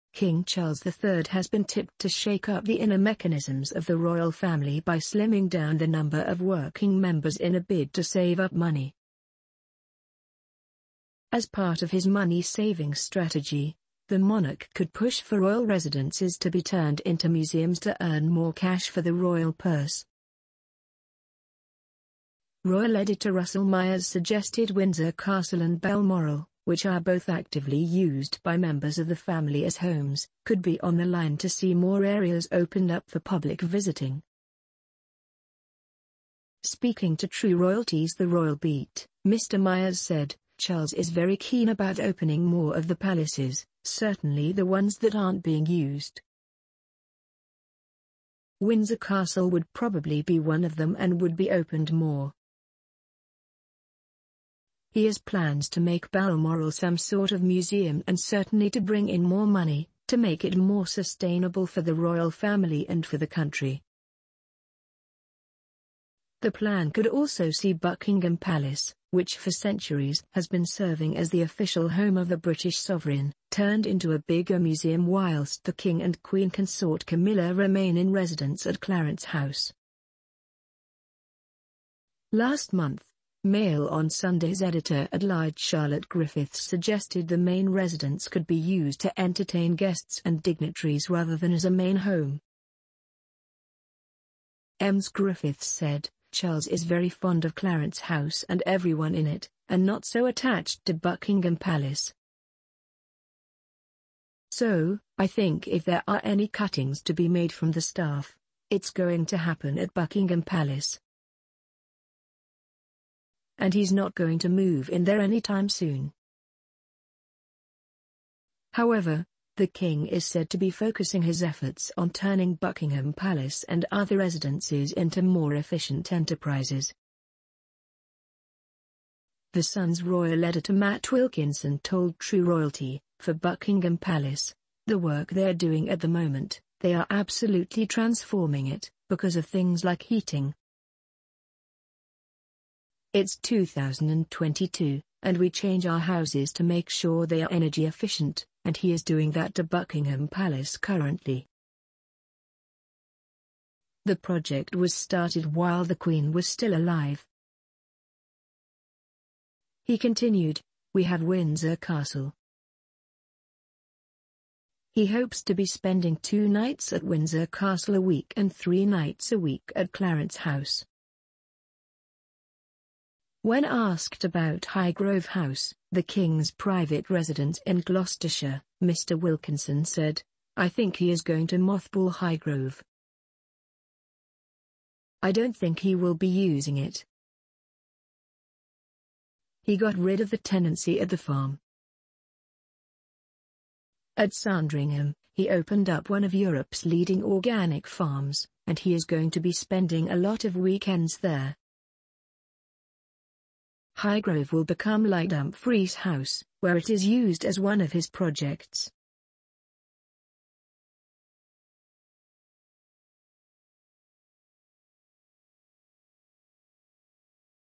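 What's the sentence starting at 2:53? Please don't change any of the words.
When asked about Highgrove House, the King's private residence in Gloucestershire, Mr.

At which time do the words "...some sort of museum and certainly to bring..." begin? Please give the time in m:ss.
0:56.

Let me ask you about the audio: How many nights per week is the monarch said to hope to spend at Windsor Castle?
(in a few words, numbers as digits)
2.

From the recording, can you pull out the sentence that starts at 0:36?
Speaking to True Royalty's The Royal Beat, Mr.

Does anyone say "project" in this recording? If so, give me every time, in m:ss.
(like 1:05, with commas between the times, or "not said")
2:34, 3:28.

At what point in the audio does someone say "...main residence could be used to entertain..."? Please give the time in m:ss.
1:27.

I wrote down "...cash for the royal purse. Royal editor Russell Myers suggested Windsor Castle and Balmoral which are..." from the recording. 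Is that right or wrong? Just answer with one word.
right.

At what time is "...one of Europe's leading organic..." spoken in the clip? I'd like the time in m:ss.
3:16.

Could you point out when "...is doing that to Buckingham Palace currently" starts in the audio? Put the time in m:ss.
2:28.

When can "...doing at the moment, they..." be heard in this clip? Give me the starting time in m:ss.
2:15.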